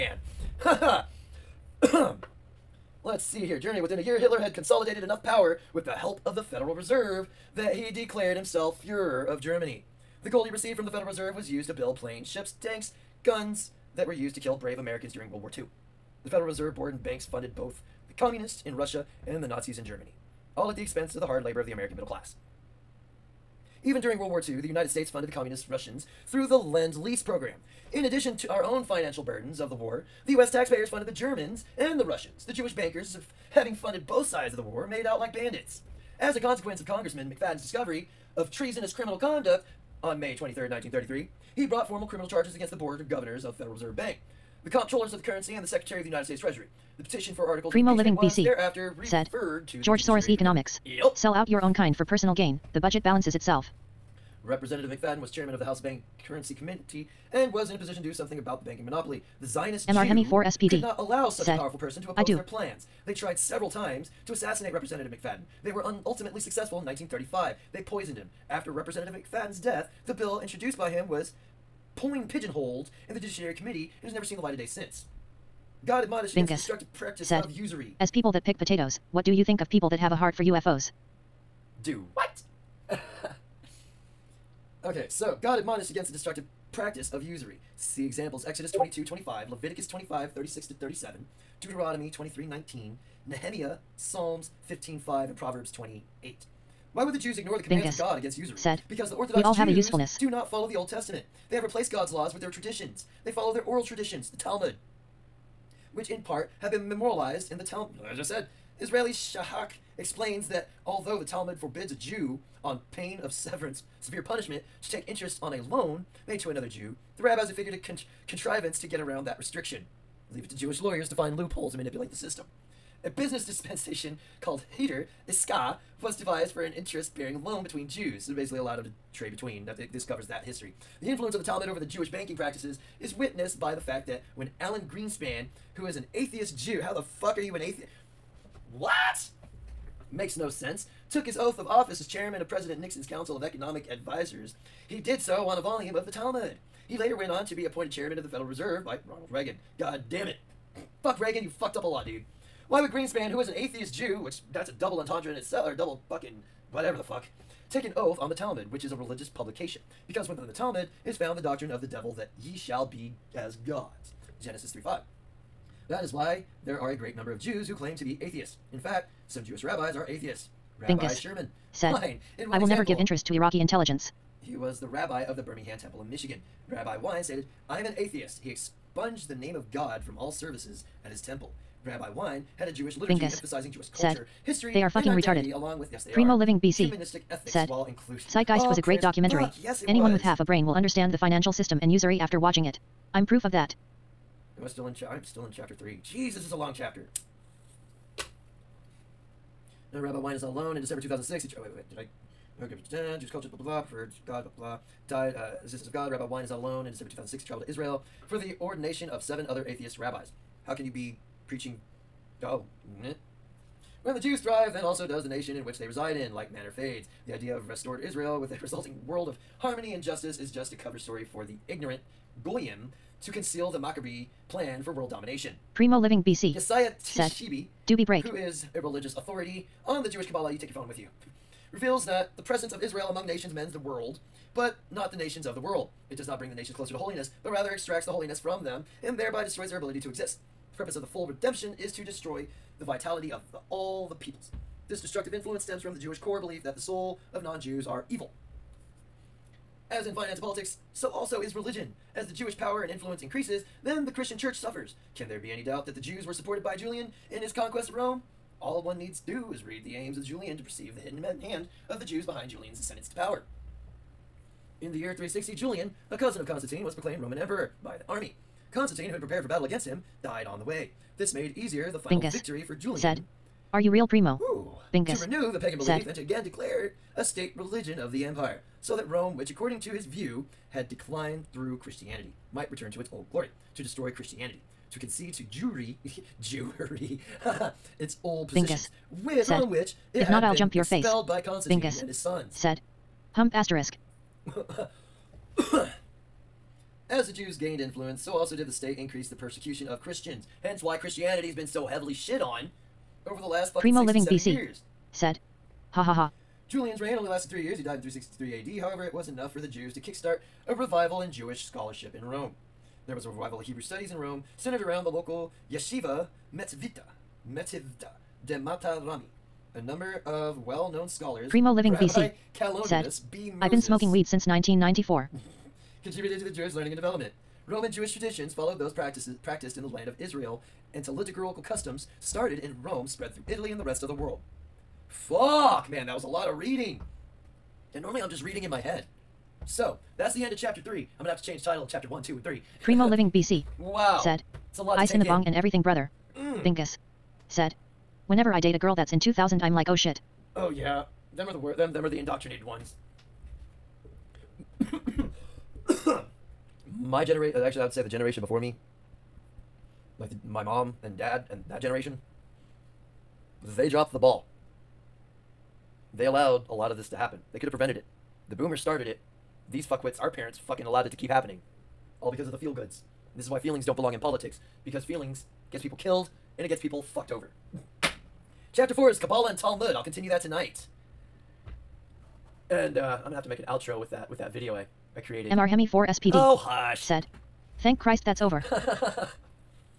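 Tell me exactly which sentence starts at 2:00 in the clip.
Leave it to Jewish lawyers to find loopholes and manipulate the system.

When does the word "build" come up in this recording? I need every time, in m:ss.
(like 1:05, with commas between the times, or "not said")
0:11.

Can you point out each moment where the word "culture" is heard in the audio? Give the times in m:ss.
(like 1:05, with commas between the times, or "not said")
3:03, 3:23.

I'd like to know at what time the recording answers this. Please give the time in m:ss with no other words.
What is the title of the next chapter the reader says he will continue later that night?
6:19.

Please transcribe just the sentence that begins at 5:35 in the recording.
Fuck, man, that was a lot of reading.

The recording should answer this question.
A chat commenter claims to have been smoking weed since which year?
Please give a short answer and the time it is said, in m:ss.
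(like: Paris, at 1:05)
1994, at 5:24.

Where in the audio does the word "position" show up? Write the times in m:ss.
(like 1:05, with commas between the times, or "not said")
0:57, 4:48.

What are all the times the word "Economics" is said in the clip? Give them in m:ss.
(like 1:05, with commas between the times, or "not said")
0:50, 2:23.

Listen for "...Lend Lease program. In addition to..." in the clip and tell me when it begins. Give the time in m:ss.
0:26.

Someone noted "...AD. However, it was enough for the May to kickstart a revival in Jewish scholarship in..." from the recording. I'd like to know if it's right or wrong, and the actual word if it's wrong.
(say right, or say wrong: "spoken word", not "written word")
wrong: "Jews", not "May".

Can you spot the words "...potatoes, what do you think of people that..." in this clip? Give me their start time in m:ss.
1:18.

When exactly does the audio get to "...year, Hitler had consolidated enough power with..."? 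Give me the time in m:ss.
0:04.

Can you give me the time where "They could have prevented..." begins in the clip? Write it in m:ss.
6:07.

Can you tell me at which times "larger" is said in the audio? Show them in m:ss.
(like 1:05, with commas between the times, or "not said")
not said.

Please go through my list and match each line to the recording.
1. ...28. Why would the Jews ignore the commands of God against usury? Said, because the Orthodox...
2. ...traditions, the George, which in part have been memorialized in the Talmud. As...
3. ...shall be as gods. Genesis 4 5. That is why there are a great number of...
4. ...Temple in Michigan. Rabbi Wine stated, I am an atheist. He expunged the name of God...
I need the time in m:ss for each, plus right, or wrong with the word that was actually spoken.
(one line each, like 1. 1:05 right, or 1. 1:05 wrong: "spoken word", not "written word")
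1. 1:35 right
2. 1:43 wrong: "Talmud", not "George"
3. 2:42 wrong: "3", not "4"
4. 2:55 right.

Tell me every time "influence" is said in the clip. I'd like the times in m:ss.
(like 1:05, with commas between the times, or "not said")
2:11, 4:05, 4:12, 4:57.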